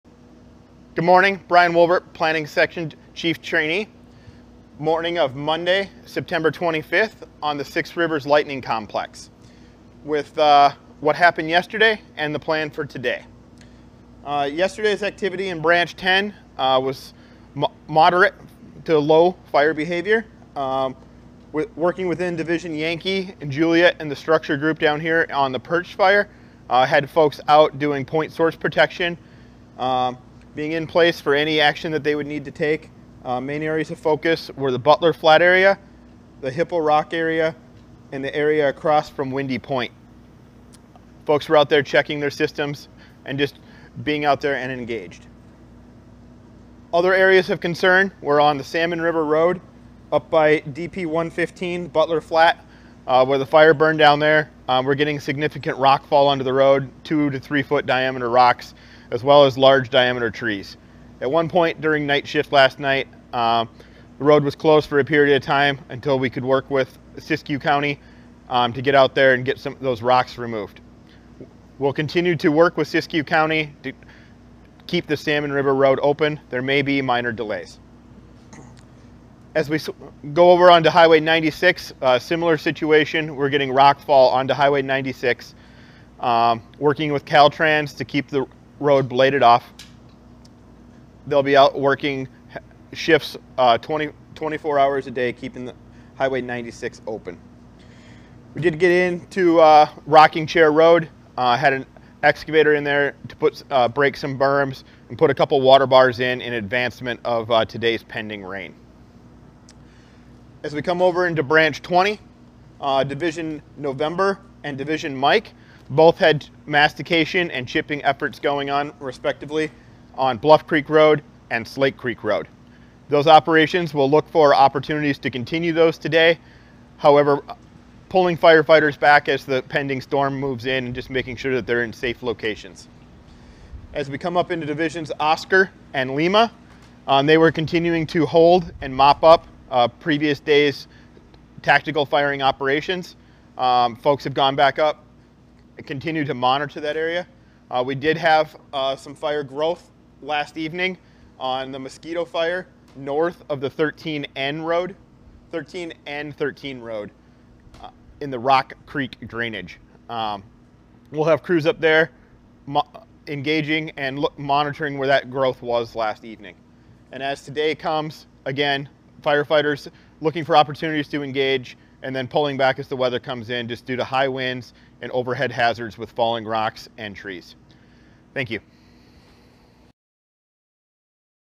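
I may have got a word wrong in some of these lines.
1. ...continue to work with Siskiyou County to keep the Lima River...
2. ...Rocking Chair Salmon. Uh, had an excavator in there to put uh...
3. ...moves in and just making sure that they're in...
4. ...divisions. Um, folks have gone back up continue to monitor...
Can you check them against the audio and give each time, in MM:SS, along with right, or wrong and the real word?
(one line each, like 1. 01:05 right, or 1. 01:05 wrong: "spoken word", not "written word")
1. 01:11 wrong: "Salmon", not "Lima"
2. 01:40 wrong: "Road", not "Salmon"
3. 02:10 right
4. 02:22 wrong: "operations", not "divisions".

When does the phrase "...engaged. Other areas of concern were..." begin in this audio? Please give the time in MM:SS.
00:44.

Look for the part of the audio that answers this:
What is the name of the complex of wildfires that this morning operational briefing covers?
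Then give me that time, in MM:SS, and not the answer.
00:07.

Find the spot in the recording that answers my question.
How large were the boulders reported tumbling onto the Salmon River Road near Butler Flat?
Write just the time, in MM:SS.
00:57.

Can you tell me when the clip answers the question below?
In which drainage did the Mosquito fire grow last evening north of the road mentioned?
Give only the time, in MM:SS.
02:38.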